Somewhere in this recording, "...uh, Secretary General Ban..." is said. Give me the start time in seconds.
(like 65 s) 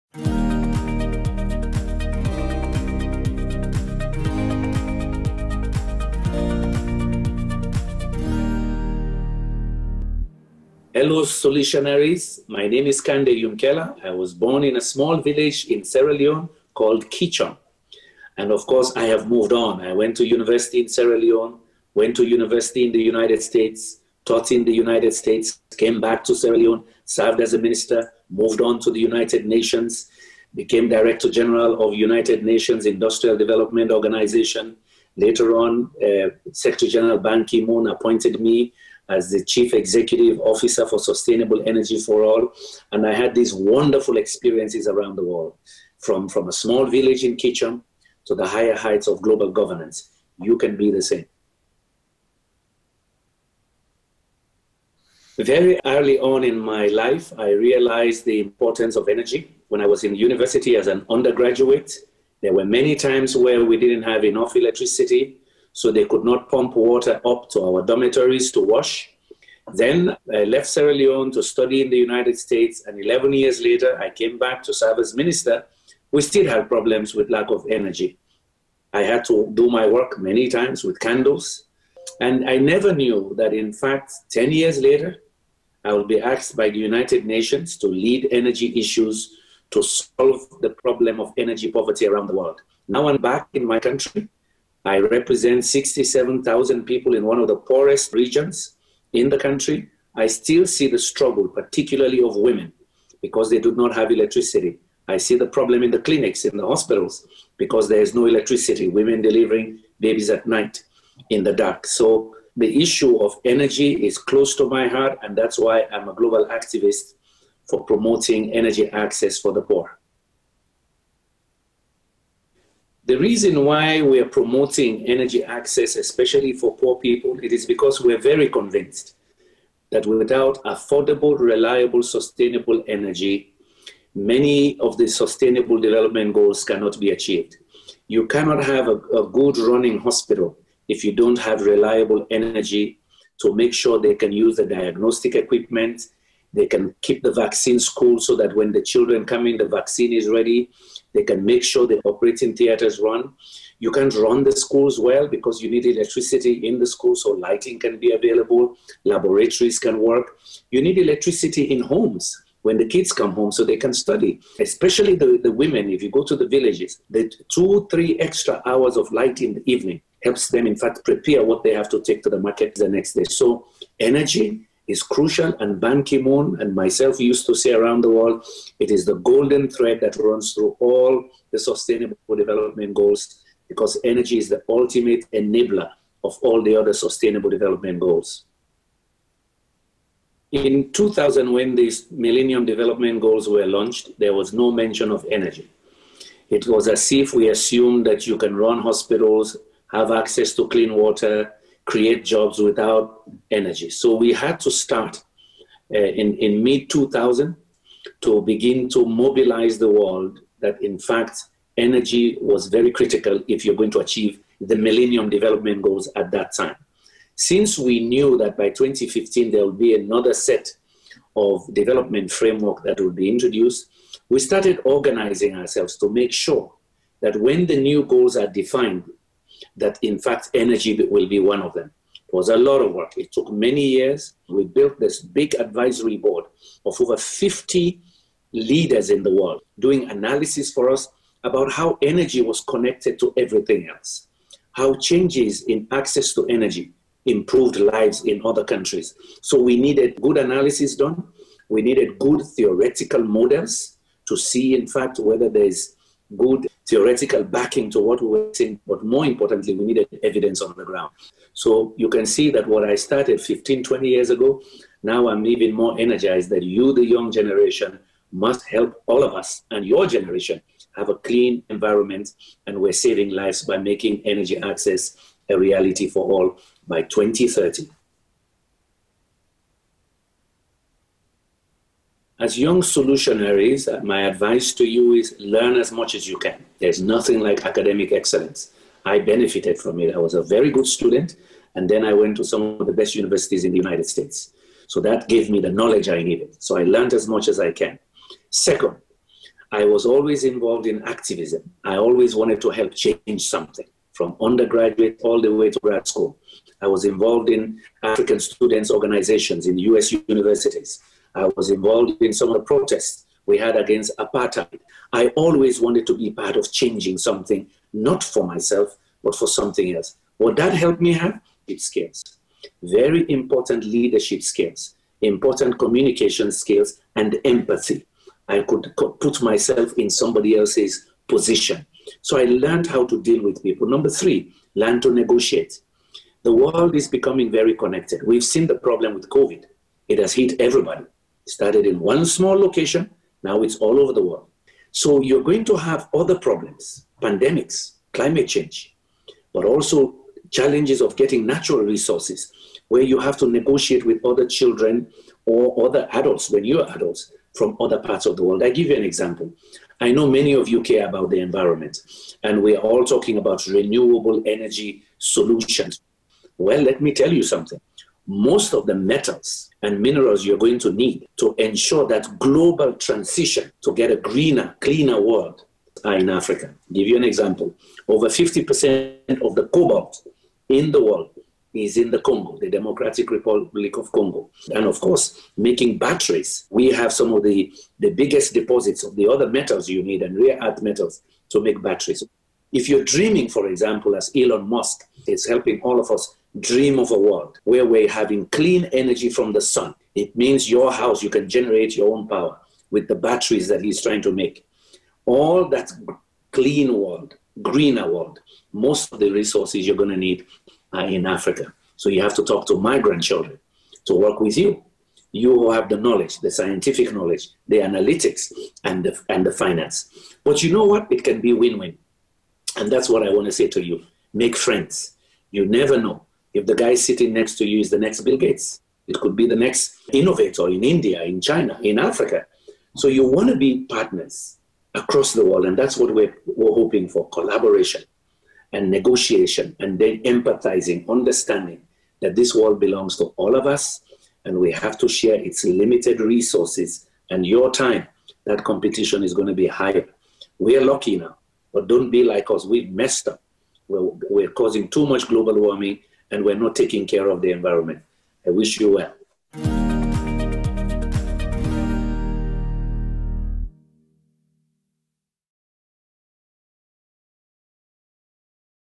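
36 s.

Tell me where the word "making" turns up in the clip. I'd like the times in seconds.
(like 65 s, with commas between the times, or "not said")
273 s, 385 s.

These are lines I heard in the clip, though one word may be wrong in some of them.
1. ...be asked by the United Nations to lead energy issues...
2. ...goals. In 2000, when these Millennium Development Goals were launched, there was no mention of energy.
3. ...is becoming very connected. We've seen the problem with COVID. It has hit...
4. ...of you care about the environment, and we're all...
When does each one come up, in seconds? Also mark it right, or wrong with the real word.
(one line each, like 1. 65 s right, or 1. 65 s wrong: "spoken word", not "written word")
1. 86 s right
2. 187 s right
3. 336 s right
4. 360 s right.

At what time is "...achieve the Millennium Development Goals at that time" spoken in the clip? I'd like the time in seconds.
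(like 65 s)
213 s.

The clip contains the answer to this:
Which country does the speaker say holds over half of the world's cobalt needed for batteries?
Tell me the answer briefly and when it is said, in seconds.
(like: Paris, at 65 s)
Democratic Republic of Congo, at 382 s.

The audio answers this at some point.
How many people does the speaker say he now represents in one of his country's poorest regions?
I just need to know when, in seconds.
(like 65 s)
95 s.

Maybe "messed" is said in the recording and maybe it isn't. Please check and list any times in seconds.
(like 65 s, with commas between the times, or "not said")
452 s.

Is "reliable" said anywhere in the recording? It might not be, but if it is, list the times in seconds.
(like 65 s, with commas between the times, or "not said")
131 s, 141 s.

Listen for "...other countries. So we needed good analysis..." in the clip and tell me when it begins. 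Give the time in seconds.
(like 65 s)
248 s.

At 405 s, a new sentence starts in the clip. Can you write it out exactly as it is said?
All that clean world, greener world, most of the resources you're going to need are in Africa.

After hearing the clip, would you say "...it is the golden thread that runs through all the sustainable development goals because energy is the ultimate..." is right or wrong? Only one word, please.
right.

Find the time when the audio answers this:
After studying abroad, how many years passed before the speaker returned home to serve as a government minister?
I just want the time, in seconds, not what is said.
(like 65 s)
73 s.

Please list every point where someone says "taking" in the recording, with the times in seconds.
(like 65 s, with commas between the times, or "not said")
456 s.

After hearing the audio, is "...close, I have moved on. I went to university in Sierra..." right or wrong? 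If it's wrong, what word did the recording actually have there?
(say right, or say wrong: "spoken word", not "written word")
wrong: "course", not "close".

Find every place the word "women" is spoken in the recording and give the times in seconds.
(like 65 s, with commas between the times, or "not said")
102 s, 108 s, 165 s.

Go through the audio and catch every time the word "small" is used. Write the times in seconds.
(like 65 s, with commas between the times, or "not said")
14 s, 46 s, 342 s.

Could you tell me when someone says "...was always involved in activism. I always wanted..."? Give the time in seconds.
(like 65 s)
299 s.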